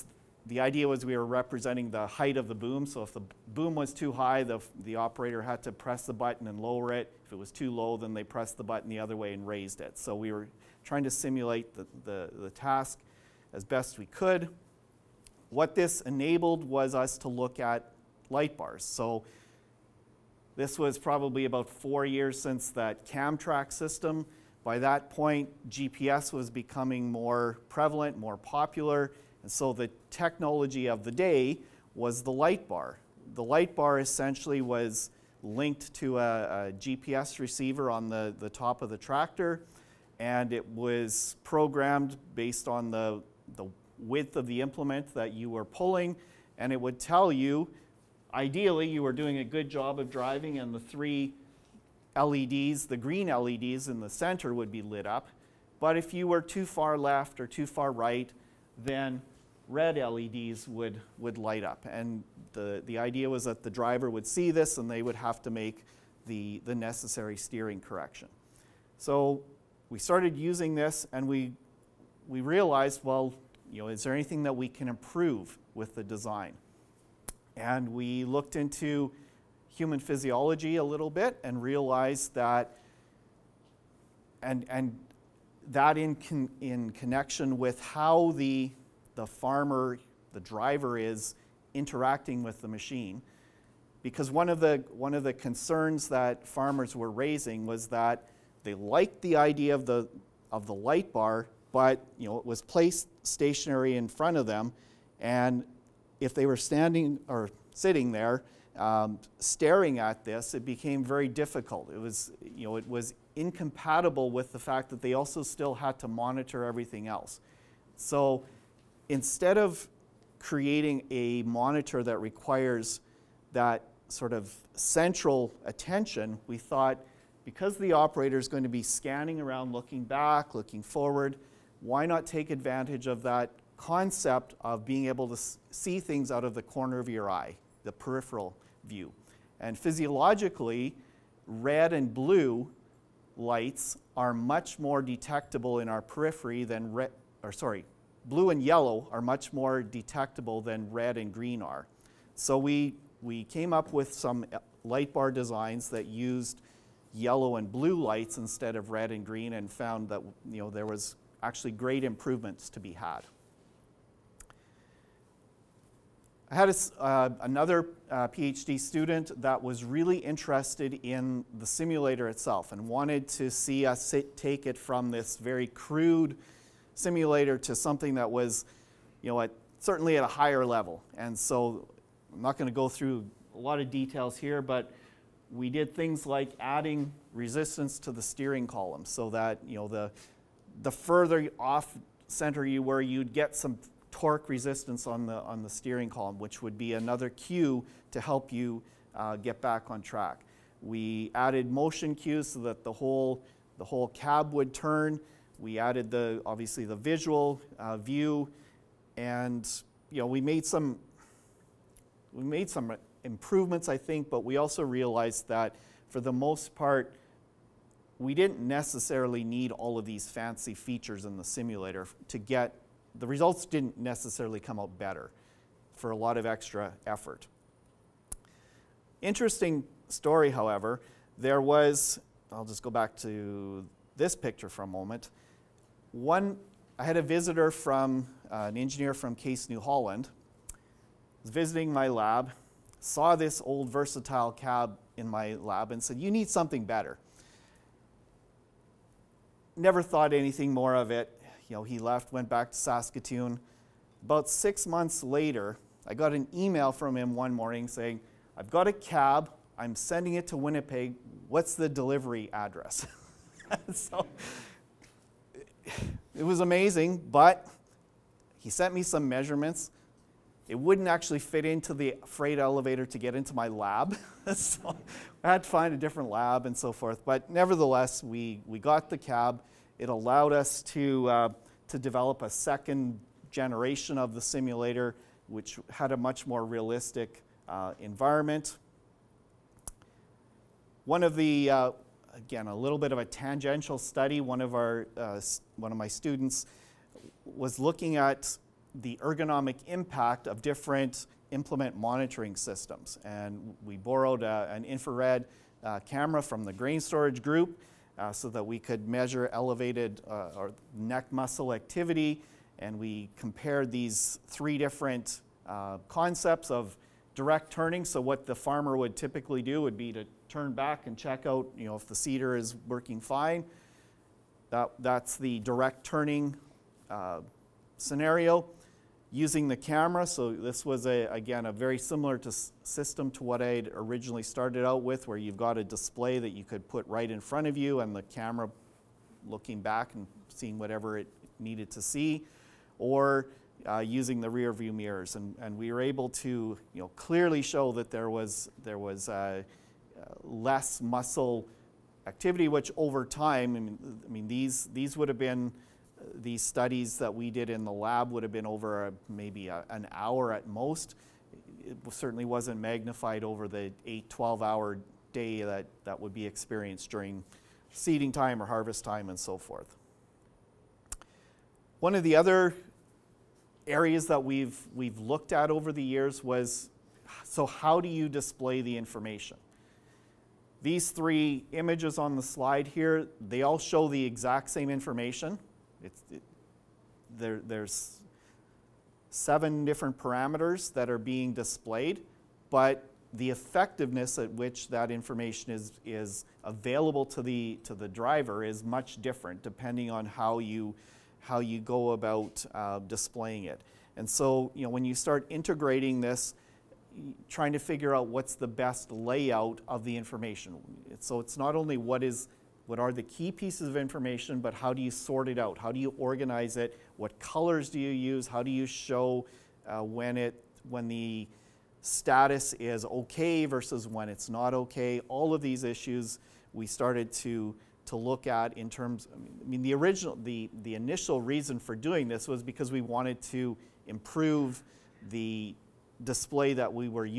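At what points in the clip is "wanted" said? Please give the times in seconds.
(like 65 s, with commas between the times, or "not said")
172 s, 433 s.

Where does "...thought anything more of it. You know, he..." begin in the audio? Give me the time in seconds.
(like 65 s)
250 s.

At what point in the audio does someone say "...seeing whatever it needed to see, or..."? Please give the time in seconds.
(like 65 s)
340 s.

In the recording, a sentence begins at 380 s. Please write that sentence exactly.
These three images on the slide here, they all show the exact same information.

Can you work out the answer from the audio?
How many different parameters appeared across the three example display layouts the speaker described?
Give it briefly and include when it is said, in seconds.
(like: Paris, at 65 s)
7, at 389 s.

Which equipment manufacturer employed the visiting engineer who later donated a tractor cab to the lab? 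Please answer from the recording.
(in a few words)
Case New Holland.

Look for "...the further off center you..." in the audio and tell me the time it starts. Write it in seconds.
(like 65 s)
190 s.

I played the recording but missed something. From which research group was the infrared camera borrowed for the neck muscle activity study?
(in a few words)
grain storage group.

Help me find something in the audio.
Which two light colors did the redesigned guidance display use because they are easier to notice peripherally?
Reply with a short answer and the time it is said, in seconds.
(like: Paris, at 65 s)
yellow and blue, at 157 s.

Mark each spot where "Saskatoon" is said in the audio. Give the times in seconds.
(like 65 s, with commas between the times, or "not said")
252 s.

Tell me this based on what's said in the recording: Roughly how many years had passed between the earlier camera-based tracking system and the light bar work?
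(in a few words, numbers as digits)
4 years.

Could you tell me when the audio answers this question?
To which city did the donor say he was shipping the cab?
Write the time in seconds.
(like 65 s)
260 s.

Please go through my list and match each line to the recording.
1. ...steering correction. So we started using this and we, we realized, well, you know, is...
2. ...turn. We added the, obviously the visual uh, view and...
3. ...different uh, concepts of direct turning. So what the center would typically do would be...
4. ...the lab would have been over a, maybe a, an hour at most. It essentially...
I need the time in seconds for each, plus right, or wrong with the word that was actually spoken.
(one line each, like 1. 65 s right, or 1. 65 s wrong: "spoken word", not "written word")
1. 67 s right
2. 204 s right
3. 314 s wrong: "farmer", not "center"
4. 357 s wrong: "certainly", not "essentially".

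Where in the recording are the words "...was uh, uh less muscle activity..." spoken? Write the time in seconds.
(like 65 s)
348 s.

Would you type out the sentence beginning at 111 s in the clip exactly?
It was, you know, it was incompatible with the fact that they also still had to monitor everything else.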